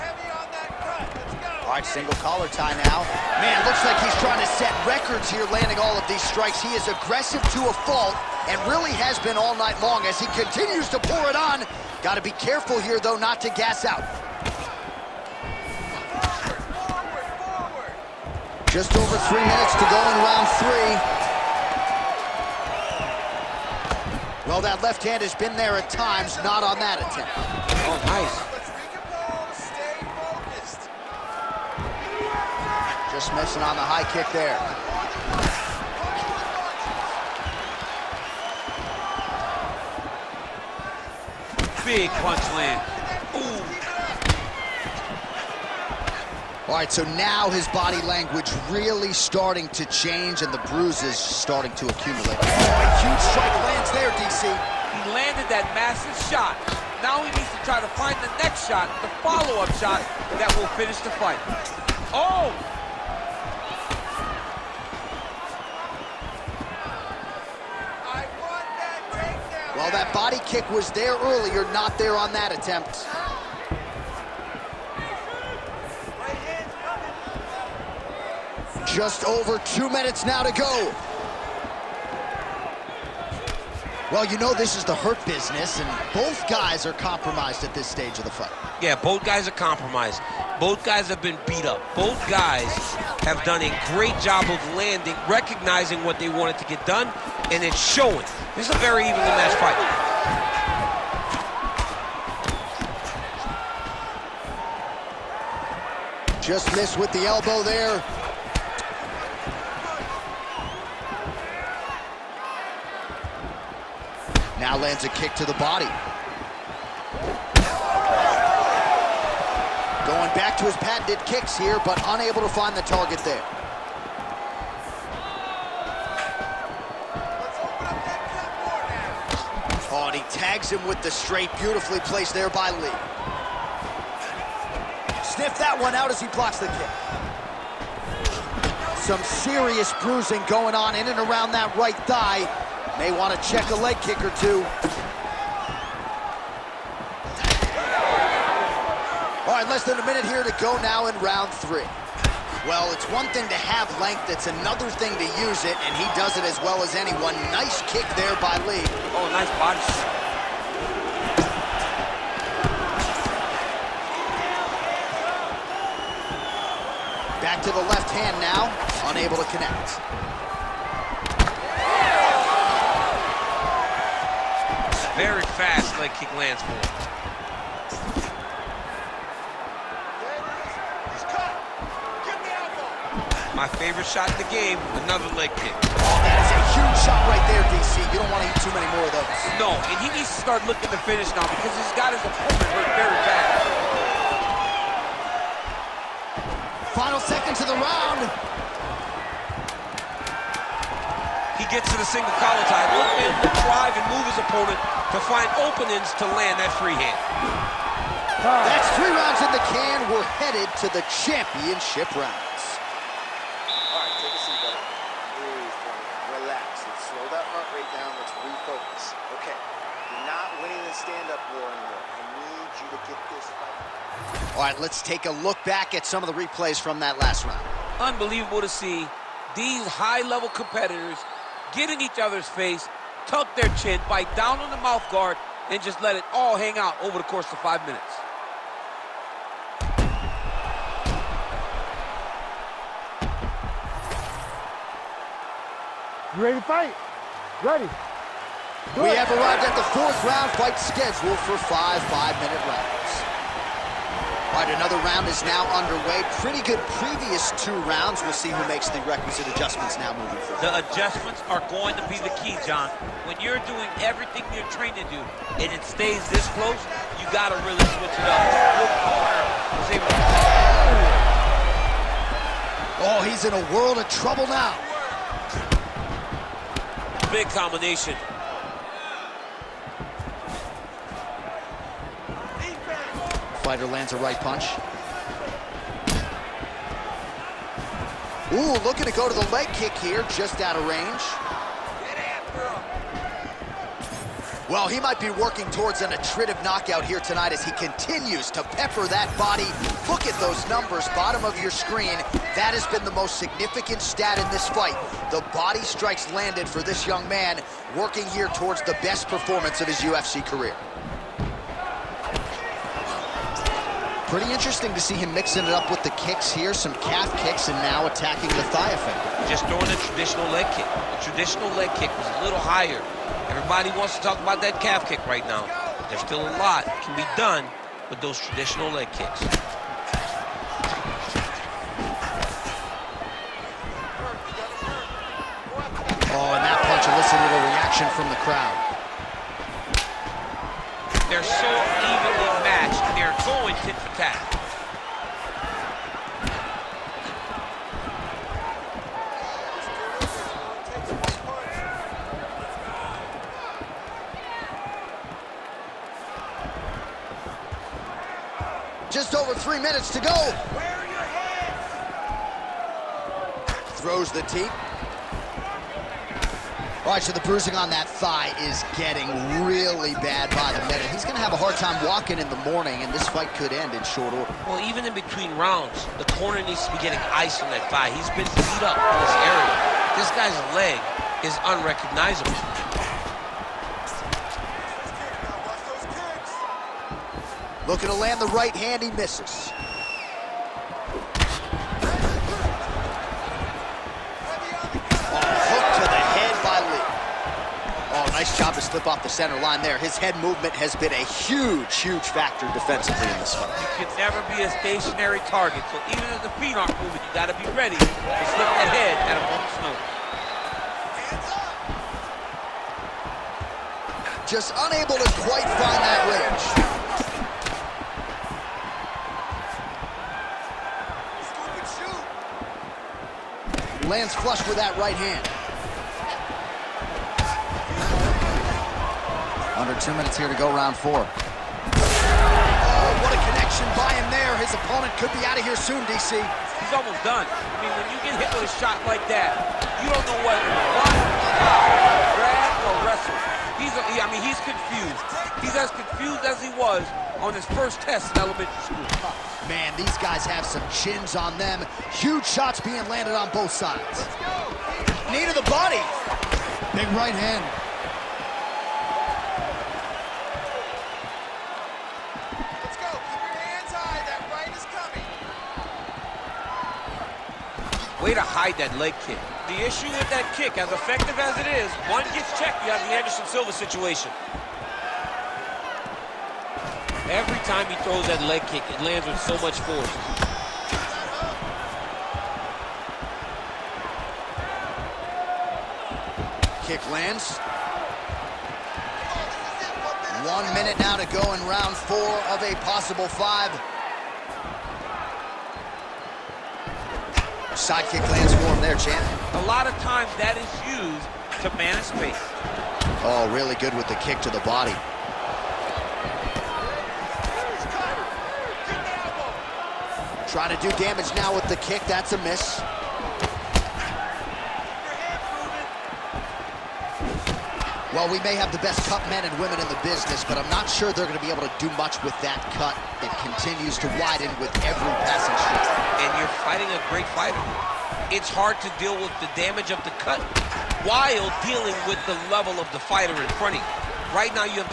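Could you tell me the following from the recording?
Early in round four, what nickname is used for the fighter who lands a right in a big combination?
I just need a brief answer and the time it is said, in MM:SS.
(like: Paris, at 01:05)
Spider, at 04:43.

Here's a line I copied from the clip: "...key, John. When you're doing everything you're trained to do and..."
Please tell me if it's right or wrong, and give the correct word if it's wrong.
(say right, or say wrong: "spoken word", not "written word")
right.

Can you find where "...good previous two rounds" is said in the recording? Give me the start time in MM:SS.
04:16.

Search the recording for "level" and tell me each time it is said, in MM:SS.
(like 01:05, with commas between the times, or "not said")
03:49, 08:52.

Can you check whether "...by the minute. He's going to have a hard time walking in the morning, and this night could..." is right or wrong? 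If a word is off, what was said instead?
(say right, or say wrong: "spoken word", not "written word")
wrong: "fight", not "night".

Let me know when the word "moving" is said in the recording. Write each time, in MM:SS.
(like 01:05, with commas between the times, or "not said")
04:20, 06:47.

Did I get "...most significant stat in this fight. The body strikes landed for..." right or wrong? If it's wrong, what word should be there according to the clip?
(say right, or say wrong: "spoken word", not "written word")
right.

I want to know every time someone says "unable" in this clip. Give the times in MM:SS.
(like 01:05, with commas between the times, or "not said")
02:02, 02:49, 06:54.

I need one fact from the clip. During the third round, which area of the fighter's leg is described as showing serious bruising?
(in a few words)
Right thigh.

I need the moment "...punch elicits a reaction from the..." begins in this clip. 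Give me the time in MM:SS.
05:36.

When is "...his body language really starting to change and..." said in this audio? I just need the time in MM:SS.
00:47.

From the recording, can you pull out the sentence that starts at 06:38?
To slip off the center line there.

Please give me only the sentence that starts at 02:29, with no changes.
All right, less than a minute here to go now in round three.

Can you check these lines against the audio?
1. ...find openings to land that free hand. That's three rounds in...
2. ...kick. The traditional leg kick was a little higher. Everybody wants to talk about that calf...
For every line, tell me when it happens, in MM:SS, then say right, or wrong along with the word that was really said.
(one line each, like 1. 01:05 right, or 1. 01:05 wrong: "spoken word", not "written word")
1. 03:25 right
2. 05:20 right.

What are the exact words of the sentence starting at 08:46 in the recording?
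And you're fighting a great fighter.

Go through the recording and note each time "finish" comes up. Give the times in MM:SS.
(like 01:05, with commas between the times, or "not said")
01:00, 03:11.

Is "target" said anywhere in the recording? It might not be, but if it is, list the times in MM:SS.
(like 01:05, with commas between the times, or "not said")
02:02, 06:45.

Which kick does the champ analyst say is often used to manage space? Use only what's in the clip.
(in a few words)
Sidekick.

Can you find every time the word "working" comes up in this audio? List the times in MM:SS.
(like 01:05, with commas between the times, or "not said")
04:55, 05:07.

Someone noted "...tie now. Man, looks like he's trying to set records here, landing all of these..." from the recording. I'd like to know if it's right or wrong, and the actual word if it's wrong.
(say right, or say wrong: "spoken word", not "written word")
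right.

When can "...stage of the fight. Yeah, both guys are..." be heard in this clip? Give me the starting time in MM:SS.
01:27.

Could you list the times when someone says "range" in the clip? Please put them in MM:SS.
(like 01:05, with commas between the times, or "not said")
04:50, 06:56.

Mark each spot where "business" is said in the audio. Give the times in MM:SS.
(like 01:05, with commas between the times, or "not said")
01:25, 08:40.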